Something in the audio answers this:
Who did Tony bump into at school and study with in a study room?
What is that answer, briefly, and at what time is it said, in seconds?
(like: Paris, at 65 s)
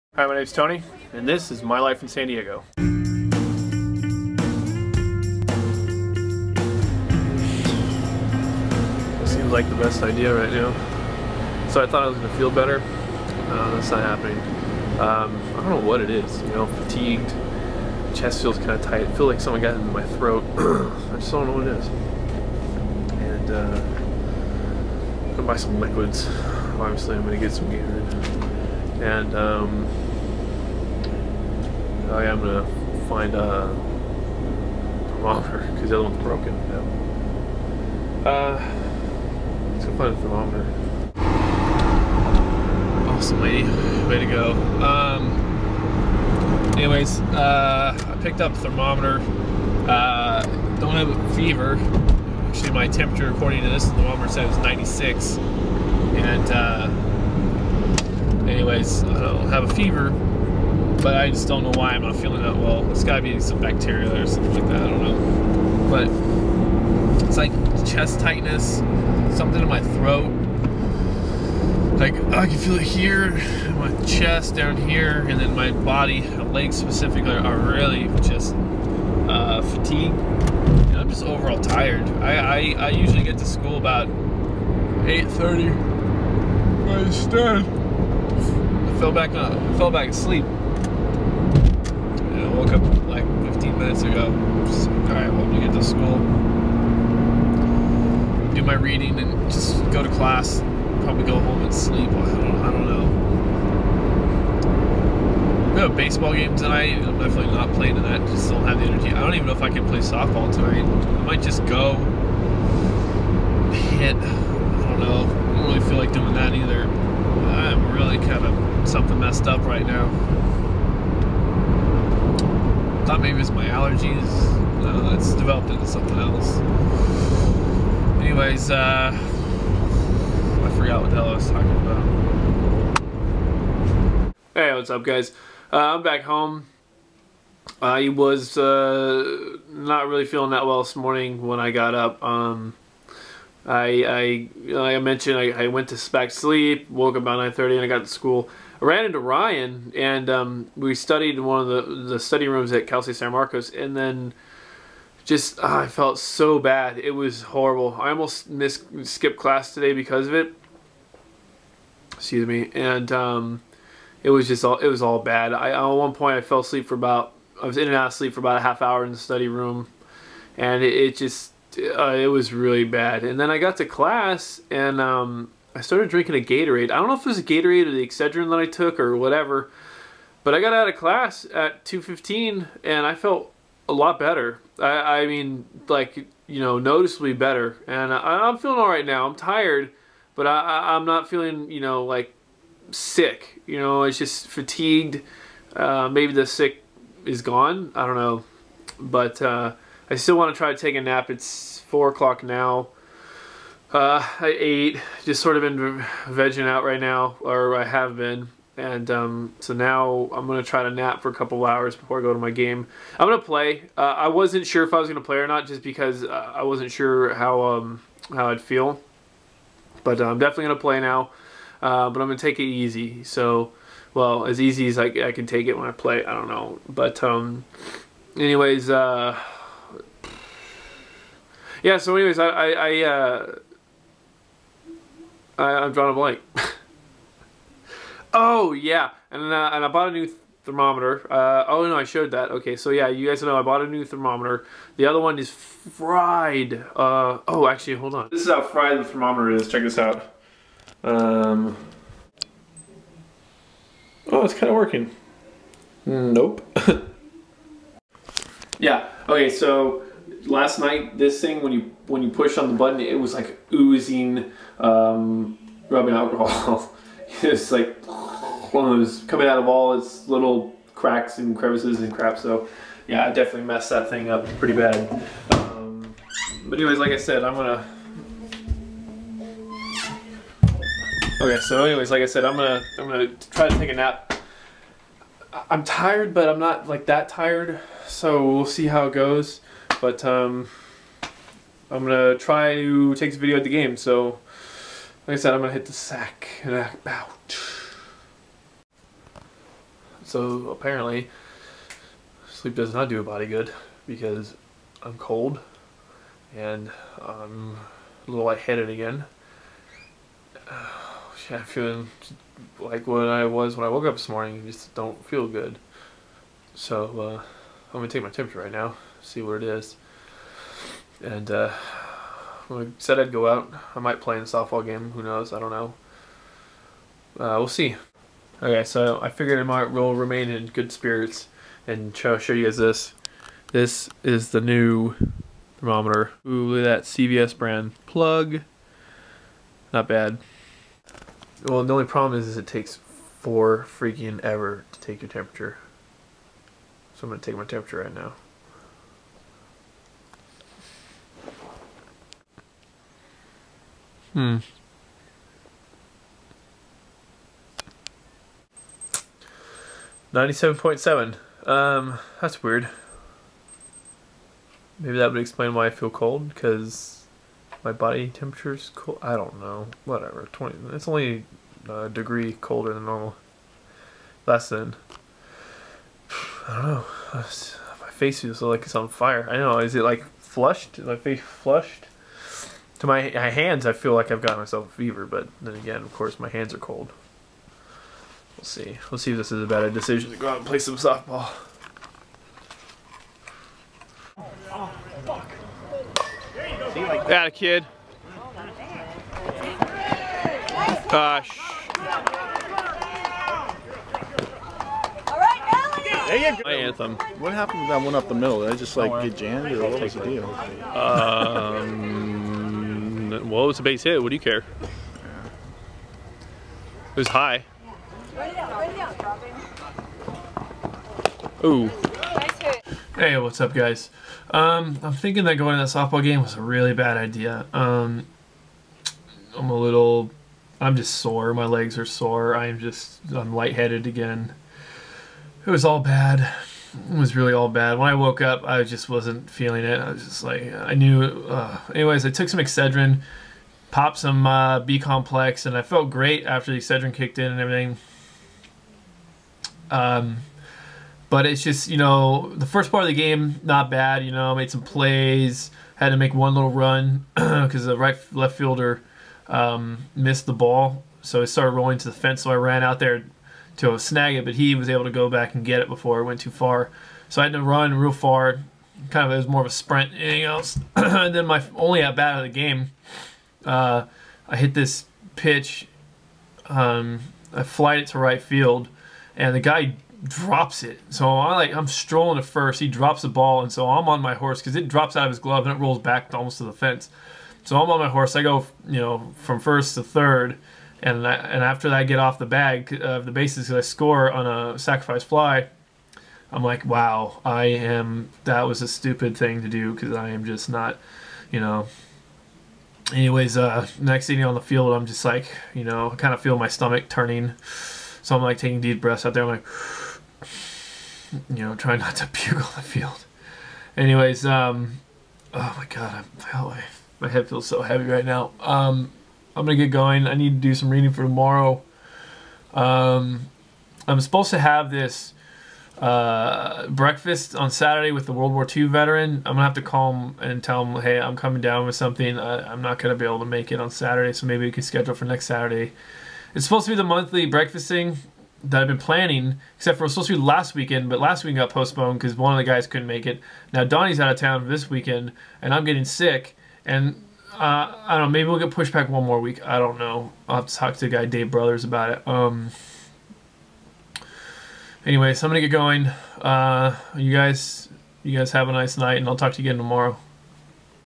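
Ryan, at 149 s.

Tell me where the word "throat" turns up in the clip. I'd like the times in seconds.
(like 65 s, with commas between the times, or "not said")
20 s, 69 s.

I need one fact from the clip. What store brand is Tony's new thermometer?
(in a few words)
CVS.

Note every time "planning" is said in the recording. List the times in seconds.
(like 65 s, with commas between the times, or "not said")
538 s.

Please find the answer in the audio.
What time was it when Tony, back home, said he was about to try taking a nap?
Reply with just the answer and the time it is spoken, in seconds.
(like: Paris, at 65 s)
4 o'clock, at 201 s.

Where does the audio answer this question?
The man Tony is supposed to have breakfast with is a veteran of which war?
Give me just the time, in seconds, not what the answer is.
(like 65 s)
528 s.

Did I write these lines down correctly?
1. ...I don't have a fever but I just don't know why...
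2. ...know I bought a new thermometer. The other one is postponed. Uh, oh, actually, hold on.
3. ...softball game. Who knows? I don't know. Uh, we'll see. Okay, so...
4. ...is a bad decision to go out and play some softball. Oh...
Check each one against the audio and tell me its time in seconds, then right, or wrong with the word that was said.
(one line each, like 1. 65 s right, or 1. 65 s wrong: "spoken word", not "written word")
1. 59 s right
2. 243 s wrong: "fried", not "postponed"
3. 324 s right
4. 389 s right.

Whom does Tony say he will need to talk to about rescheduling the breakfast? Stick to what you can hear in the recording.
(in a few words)
Dave Brothers.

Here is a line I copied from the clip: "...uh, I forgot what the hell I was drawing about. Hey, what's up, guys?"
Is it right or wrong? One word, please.
wrong.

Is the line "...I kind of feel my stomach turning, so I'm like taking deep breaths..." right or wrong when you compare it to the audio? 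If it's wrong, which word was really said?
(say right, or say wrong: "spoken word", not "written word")
right.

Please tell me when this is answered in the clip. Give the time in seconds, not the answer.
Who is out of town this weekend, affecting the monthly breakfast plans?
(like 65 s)
543 s.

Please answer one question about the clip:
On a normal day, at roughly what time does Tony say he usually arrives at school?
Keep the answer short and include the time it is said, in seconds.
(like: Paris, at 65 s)
8:30, at 84 s.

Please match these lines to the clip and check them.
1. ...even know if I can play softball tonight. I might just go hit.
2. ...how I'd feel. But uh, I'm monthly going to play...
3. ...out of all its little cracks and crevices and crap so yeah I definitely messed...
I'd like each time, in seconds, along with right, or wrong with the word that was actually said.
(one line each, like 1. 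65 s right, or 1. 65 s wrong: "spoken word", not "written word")
1. 109 s right
2. 218 s wrong: "definitely", not "monthly"
3. 269 s right.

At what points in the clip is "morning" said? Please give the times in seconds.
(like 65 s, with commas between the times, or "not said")
140 s, 314 s.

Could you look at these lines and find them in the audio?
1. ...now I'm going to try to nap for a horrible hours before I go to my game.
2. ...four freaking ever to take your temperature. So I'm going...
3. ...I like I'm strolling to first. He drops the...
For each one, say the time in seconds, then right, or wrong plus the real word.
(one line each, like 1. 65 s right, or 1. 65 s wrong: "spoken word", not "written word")
1. 209 s wrong: "couple", not "horrible"
2. 343 s right
3. 481 s right.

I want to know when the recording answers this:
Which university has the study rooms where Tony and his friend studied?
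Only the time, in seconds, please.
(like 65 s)
152 s.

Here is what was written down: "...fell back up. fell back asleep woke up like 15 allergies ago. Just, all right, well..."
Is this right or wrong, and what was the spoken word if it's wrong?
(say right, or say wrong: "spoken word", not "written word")
wrong: "minutes", not "allergies".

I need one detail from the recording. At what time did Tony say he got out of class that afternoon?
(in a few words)
2:15.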